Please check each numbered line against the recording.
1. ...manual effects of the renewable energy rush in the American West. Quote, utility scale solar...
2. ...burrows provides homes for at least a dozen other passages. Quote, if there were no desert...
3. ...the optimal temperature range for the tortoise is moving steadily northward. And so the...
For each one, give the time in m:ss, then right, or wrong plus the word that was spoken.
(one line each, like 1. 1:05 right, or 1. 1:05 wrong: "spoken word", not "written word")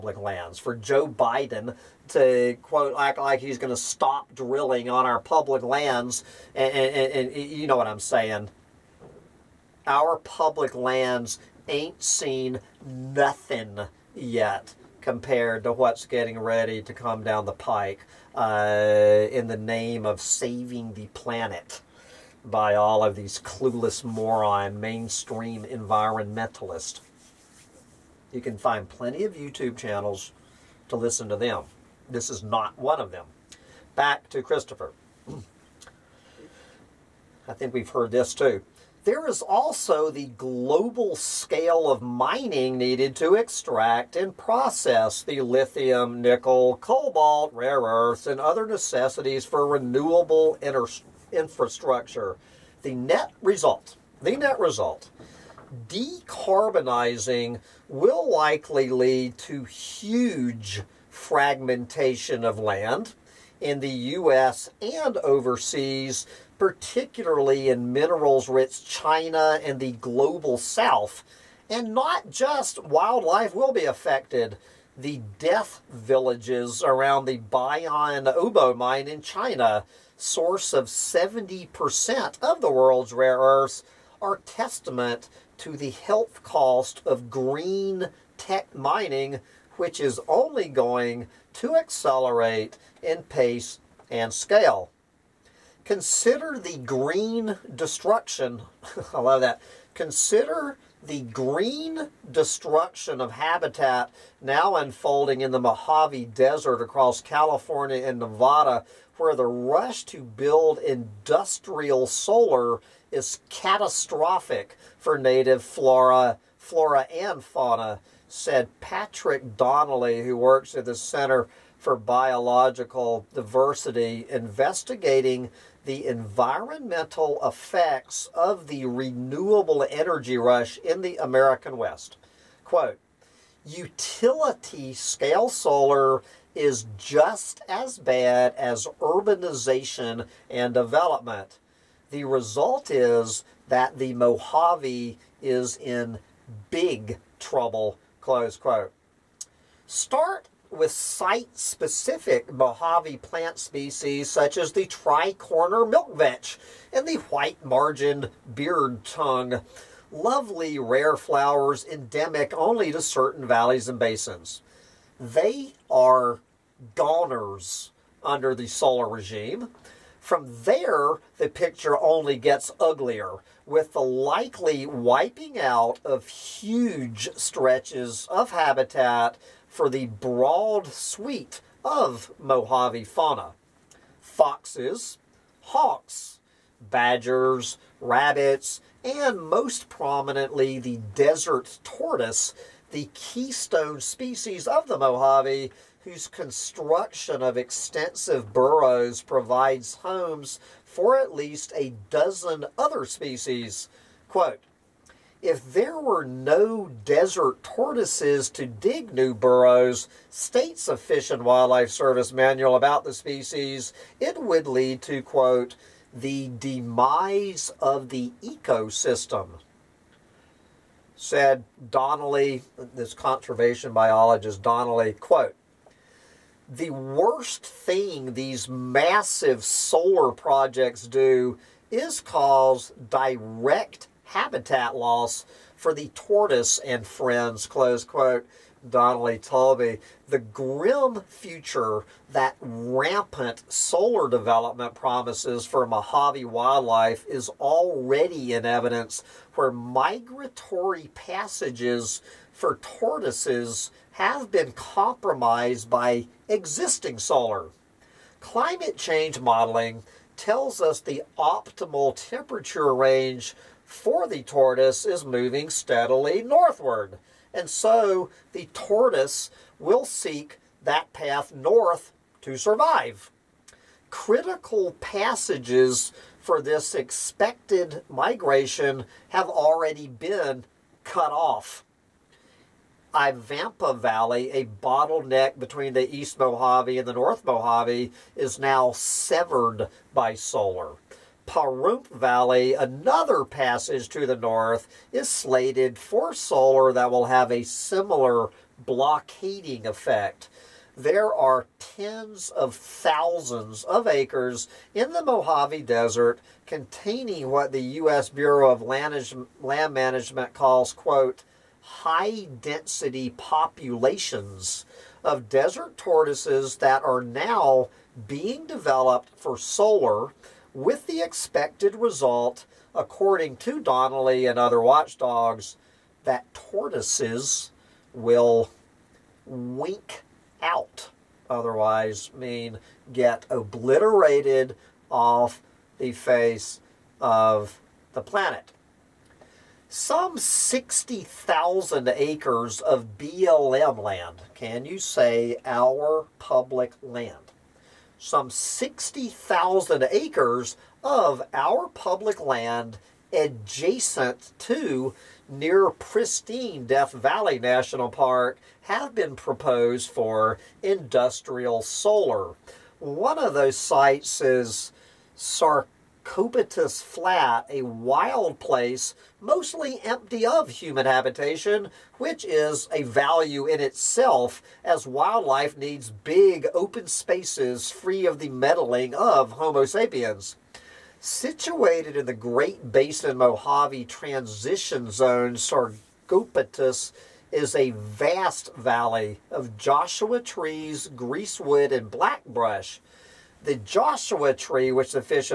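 1. 2:06 wrong: "environmental", not "manual"
2. 3:18 wrong: "species", not "passages"
3. 4:21 right.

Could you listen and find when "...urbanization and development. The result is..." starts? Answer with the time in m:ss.
2:18.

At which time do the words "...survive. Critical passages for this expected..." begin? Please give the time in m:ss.
4:32.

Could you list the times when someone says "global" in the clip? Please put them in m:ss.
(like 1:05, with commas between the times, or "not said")
0:40, 1:09.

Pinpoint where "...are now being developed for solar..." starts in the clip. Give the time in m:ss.
5:17.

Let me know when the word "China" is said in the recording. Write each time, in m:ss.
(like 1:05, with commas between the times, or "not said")
1:08, 1:19.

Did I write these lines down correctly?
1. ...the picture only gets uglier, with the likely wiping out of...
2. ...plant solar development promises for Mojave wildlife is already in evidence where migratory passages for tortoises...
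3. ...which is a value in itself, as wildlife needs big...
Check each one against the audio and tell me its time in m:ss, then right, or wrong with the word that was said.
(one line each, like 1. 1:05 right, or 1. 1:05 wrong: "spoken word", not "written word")
1. 2:51 right
2. 4:02 wrong: "rampant", not "plant"
3. 6:12 right.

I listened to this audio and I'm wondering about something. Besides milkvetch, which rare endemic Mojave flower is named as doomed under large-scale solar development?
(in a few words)
White-margined beard tongue.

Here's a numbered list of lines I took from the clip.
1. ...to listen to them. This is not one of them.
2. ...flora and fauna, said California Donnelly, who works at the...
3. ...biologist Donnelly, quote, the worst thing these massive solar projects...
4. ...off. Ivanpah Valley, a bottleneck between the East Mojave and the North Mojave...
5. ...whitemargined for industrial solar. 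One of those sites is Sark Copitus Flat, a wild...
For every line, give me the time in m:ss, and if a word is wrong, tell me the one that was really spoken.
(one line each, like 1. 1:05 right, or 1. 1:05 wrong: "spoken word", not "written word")
1. 0:30 right
2. 1:56 wrong: "Patrick", not "California"
3. 3:43 right
4. 4:41 right
5. 5:59 wrong: "proposed", not "whitemargined".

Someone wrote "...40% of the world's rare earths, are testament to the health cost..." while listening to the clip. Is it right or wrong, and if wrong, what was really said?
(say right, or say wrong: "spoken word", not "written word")
wrong: "70", not "40".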